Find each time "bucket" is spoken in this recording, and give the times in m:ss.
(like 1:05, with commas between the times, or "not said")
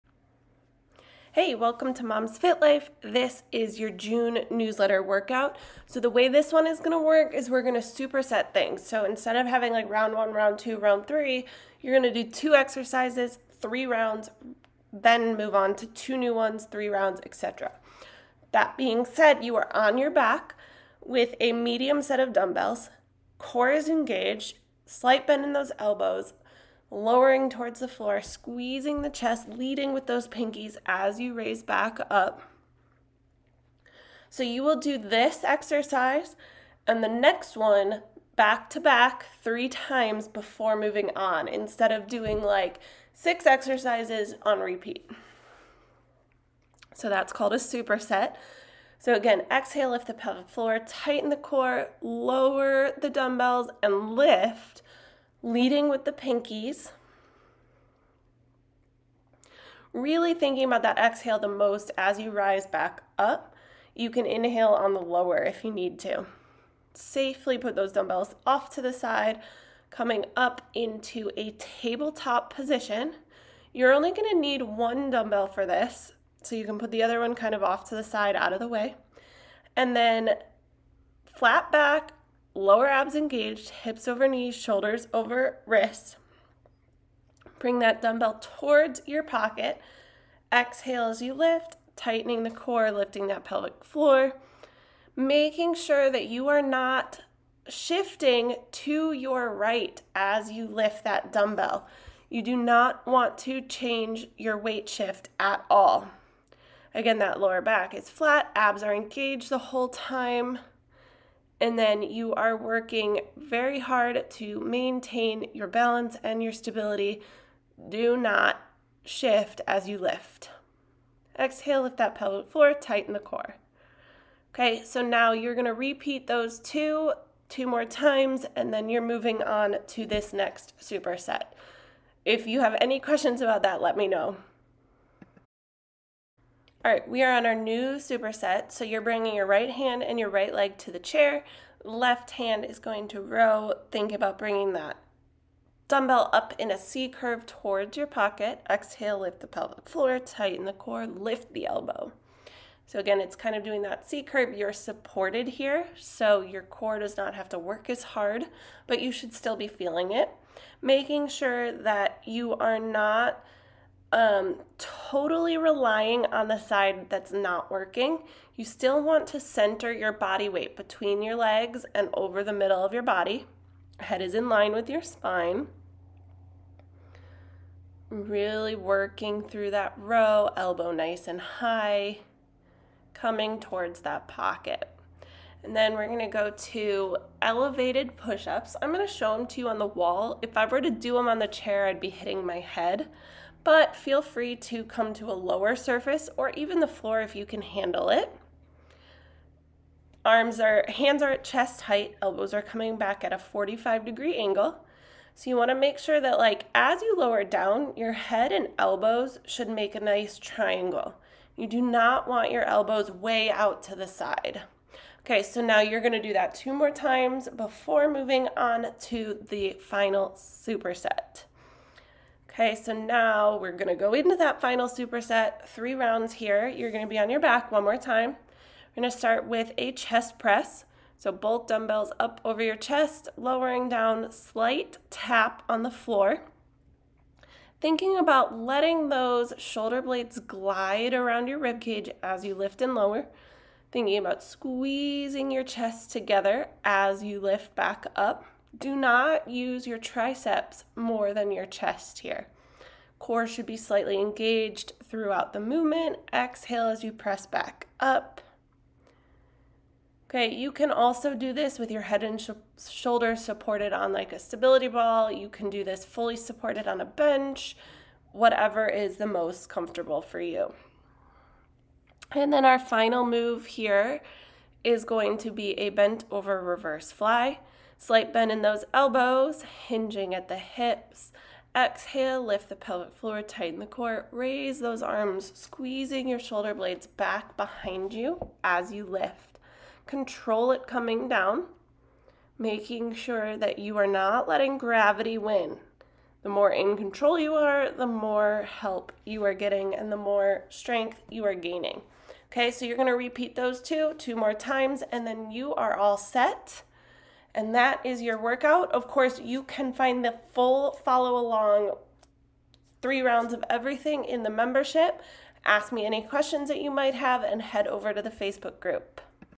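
not said.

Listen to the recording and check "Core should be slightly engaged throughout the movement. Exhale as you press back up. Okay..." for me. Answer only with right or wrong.
right.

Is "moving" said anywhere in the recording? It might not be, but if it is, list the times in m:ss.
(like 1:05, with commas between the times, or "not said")
0:40, 2:09, 3:38.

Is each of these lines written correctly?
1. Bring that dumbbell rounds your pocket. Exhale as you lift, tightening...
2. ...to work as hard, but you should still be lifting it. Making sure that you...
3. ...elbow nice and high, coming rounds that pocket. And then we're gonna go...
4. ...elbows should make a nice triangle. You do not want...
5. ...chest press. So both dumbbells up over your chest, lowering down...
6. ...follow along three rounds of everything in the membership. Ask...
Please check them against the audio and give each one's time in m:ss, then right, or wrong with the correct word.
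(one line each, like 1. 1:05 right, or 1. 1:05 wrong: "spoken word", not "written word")
1. 1:27 wrong: "towards", not "rounds"
2. 2:37 wrong: "feeling", not "lifting"
3. 3:00 wrong: "towards", not "rounds"
4. 3:28 right
5. 3:49 right
6. 5:11 right.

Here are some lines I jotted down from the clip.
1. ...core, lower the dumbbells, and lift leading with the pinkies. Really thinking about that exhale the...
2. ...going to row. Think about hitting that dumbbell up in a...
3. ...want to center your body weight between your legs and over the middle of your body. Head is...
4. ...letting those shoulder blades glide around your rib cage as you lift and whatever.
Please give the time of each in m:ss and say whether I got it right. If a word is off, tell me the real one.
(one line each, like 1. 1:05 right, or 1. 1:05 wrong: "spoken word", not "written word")
1. 0:51 right
2. 2:22 wrong: "bringing", not "hitting"
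3. 2:49 right
4. 3:58 wrong: "lower", not "whatever".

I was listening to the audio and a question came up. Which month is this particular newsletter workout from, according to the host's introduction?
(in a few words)
June.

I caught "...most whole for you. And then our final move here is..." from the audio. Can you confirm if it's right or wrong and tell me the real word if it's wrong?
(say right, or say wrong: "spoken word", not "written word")
wrong: "comfortable", not "whole".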